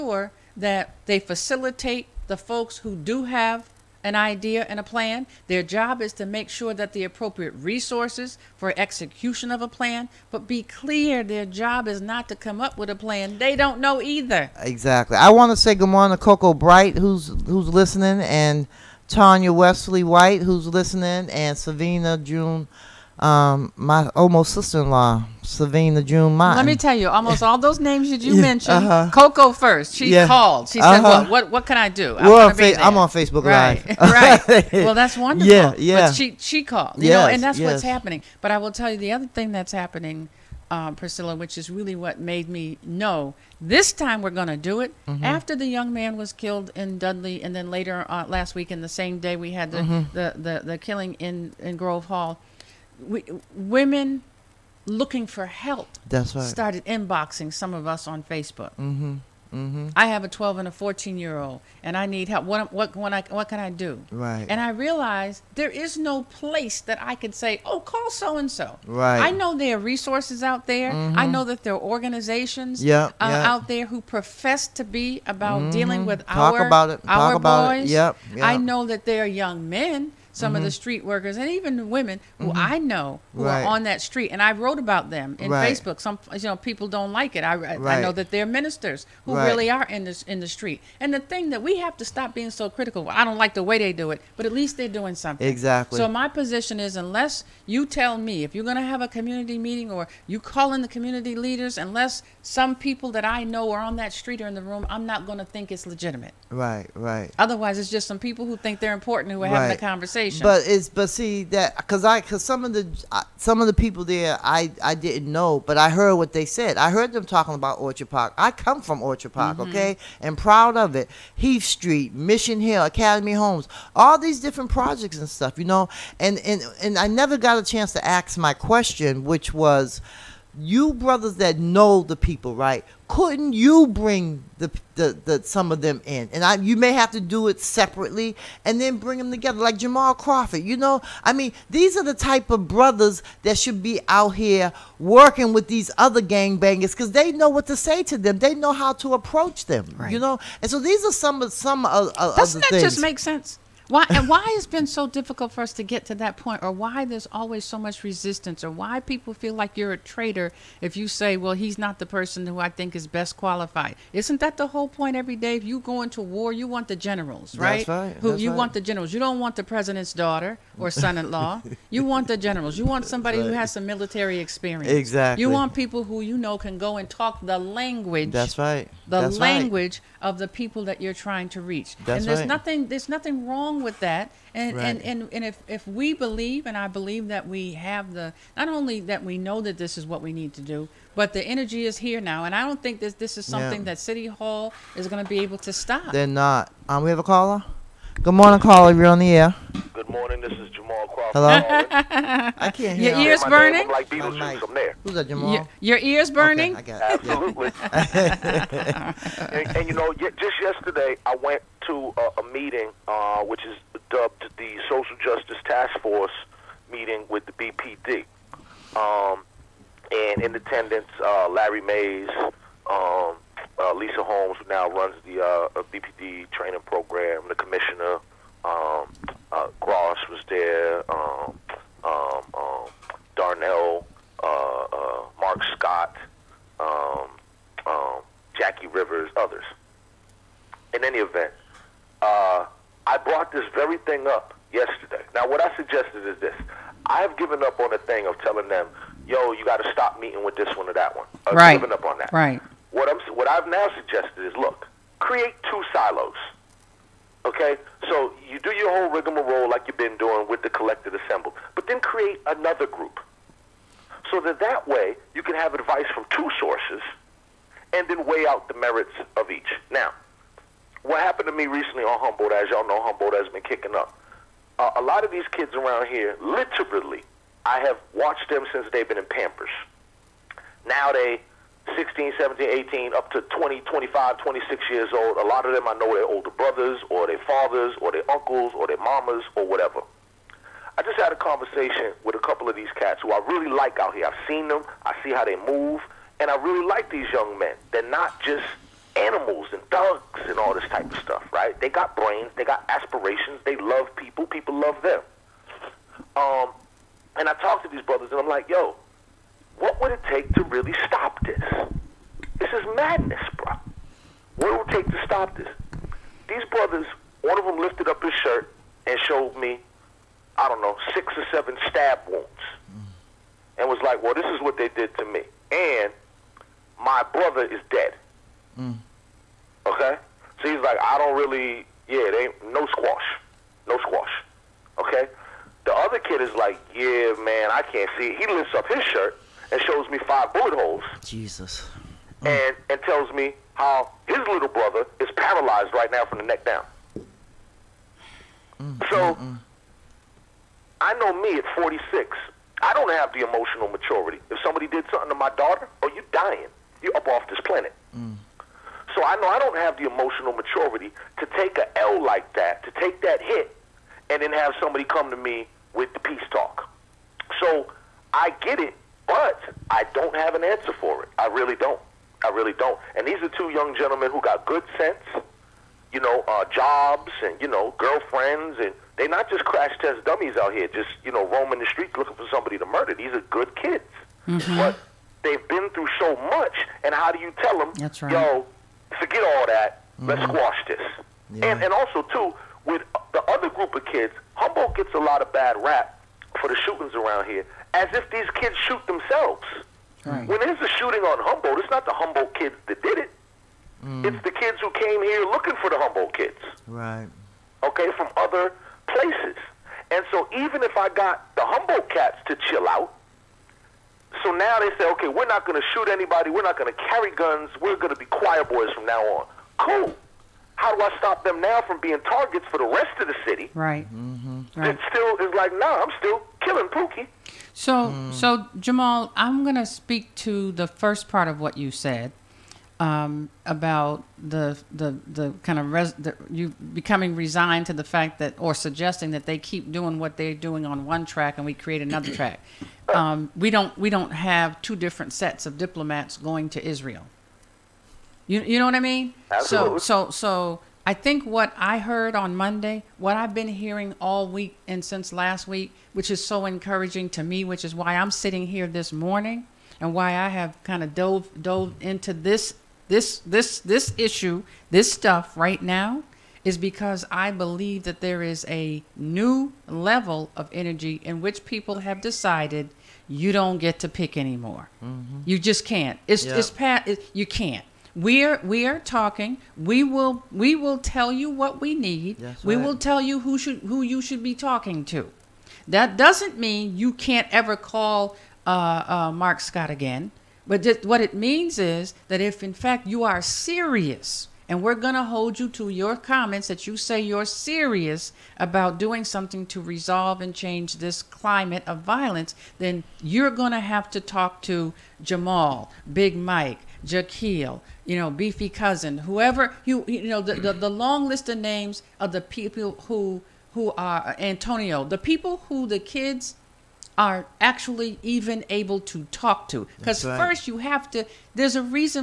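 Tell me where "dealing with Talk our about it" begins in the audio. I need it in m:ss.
1:15.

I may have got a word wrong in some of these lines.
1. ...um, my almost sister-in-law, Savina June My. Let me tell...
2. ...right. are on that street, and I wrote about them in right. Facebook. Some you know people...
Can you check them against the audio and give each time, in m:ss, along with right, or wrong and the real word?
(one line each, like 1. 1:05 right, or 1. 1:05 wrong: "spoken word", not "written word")
1. 0:23 right
2. 1:23 right.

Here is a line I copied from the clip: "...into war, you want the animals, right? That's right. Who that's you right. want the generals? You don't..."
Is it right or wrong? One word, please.
wrong.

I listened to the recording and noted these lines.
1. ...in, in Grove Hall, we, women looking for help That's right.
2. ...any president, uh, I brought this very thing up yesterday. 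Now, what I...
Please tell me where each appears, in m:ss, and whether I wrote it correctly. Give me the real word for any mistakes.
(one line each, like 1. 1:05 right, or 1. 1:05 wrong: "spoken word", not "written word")
1. 0:51 right
2. 4:01 wrong: "event", not "president".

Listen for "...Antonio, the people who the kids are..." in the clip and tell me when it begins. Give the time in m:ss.
8:34.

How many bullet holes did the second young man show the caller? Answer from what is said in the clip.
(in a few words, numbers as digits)
5.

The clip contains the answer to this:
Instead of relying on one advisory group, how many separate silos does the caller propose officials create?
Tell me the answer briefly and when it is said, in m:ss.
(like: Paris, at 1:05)
2, at 4:15.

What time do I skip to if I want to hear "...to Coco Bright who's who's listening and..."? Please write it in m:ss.
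0:16.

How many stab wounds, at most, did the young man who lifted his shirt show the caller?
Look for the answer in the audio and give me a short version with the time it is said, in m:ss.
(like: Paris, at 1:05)
7, at 5:21.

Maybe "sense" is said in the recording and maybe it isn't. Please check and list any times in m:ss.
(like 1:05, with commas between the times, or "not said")
2:33, 6:14.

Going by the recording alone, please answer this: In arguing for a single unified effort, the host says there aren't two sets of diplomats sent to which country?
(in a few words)
Israel.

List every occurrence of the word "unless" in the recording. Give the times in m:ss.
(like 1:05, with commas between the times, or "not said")
1:36, 1:41.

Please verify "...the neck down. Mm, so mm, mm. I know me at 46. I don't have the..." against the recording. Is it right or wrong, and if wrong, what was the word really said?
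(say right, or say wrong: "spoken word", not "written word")
right.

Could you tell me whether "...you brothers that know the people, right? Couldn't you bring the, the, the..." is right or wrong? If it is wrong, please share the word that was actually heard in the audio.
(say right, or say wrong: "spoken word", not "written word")
right.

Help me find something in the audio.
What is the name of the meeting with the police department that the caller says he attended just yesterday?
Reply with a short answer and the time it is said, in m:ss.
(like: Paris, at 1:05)
Social Justice Task Force, at 3:34.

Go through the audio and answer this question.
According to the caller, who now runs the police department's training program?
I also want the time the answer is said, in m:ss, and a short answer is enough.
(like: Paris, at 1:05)
Lisa Holmes, at 3:43.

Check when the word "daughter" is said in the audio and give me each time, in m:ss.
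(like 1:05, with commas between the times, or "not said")
2:50, 5:55.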